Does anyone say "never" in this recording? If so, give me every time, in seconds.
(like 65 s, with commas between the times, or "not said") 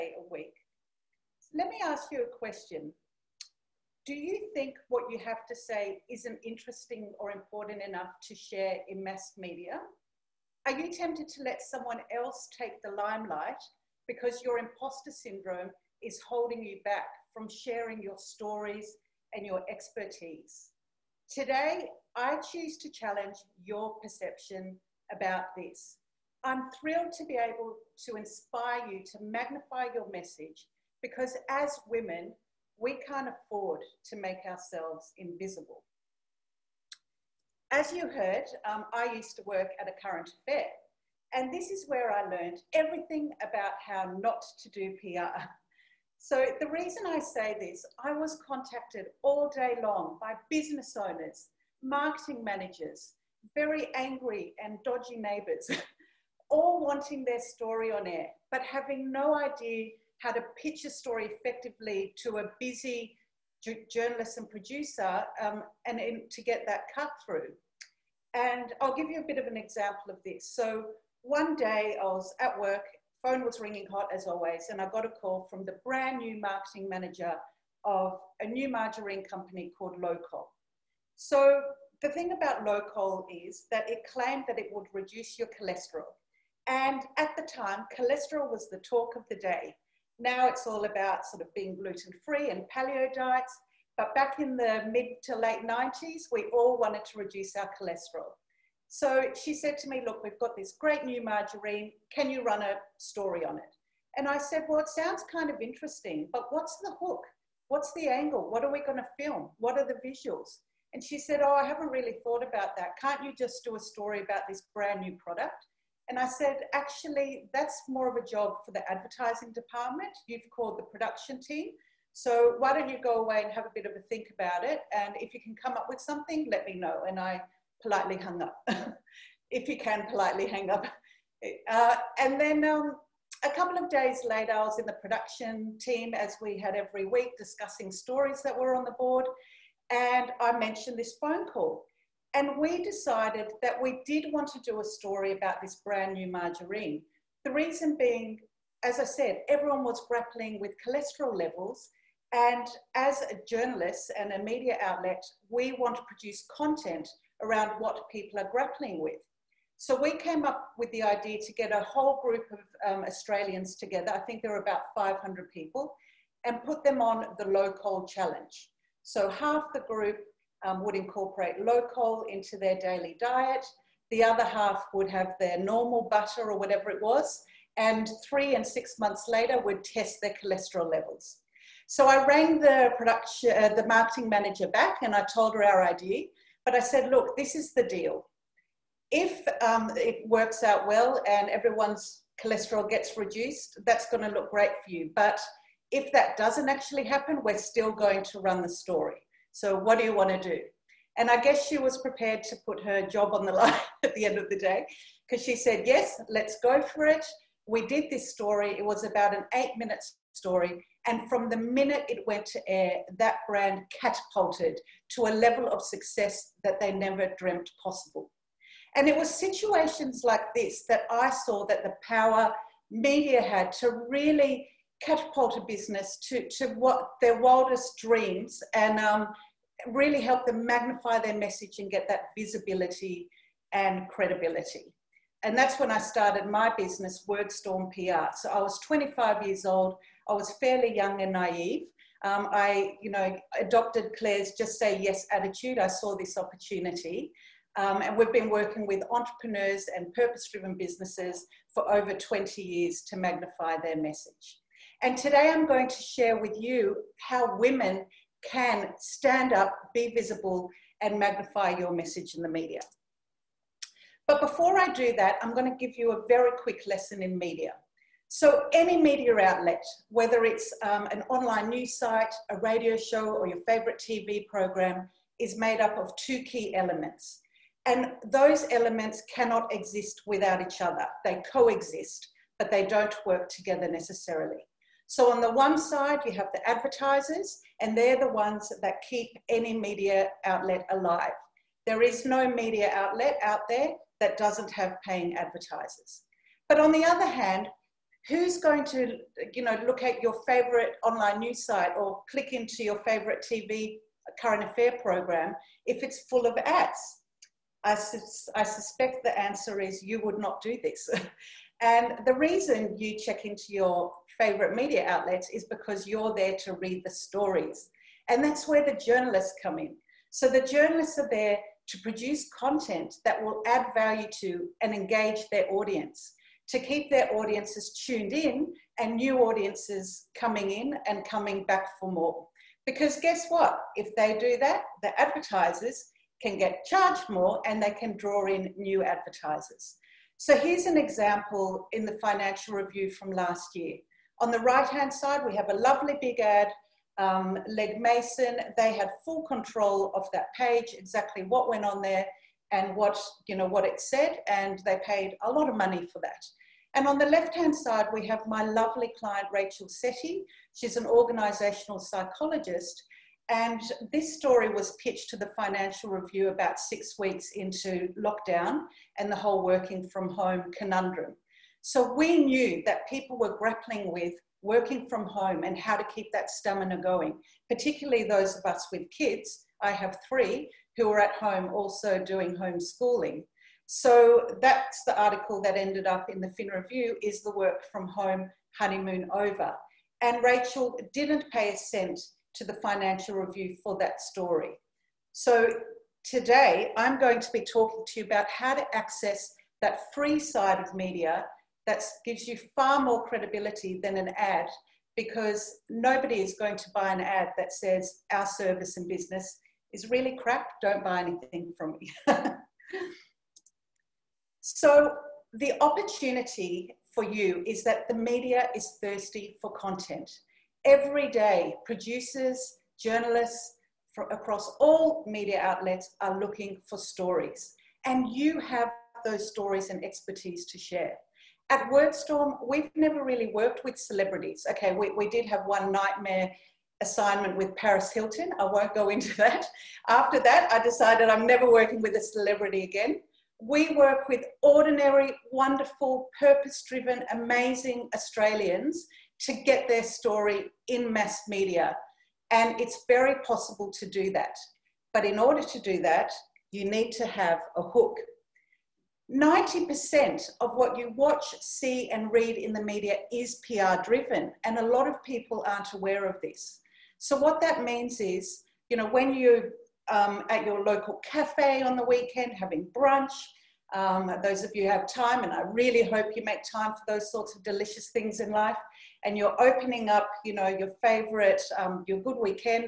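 216 s, 432 s, 441 s.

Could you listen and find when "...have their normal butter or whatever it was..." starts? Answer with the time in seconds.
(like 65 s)
175 s.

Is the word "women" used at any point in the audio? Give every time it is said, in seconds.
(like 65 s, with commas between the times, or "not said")
31 s, 257 s.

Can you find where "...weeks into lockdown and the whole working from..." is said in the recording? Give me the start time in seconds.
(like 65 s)
367 s.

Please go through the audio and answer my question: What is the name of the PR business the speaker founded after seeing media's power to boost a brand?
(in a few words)
WordStorm PR.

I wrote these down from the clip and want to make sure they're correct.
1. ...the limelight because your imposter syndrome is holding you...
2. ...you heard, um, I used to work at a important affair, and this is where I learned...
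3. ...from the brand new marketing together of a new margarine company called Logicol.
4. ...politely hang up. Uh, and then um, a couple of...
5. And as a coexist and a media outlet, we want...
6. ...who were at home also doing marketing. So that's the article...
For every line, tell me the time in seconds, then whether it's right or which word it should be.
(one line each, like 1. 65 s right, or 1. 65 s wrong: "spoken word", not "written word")
1. 12 s right
2. 37 s wrong: "current", not "important"
3. 75 s wrong: "manager", not "together"
4. 130 s right
5. 152 s wrong: "journalist", not "coexist"
6. 380 s wrong: "homeschooling", not "marketing".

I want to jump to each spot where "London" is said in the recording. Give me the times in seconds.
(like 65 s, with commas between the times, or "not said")
not said.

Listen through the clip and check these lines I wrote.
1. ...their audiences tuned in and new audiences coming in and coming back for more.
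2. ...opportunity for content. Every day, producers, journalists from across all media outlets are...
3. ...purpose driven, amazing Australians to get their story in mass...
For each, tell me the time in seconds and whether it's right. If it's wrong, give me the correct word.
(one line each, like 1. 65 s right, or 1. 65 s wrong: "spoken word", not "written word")
1. 327 s right
2. 419 s wrong: "thirsty", not "opportunity"
3. 446 s right.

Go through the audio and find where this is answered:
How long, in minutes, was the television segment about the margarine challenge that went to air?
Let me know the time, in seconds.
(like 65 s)
209 s.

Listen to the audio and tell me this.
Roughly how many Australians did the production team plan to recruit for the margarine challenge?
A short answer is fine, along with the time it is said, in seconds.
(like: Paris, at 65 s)
500, at 164 s.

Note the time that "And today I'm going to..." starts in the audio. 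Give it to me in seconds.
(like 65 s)
255 s.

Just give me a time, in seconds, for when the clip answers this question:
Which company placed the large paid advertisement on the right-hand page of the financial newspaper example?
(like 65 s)
347 s.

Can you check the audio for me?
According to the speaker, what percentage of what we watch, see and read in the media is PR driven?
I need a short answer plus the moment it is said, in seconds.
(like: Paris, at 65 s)
90%, at 459 s.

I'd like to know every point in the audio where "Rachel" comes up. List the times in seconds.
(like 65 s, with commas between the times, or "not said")
359 s, 390 s.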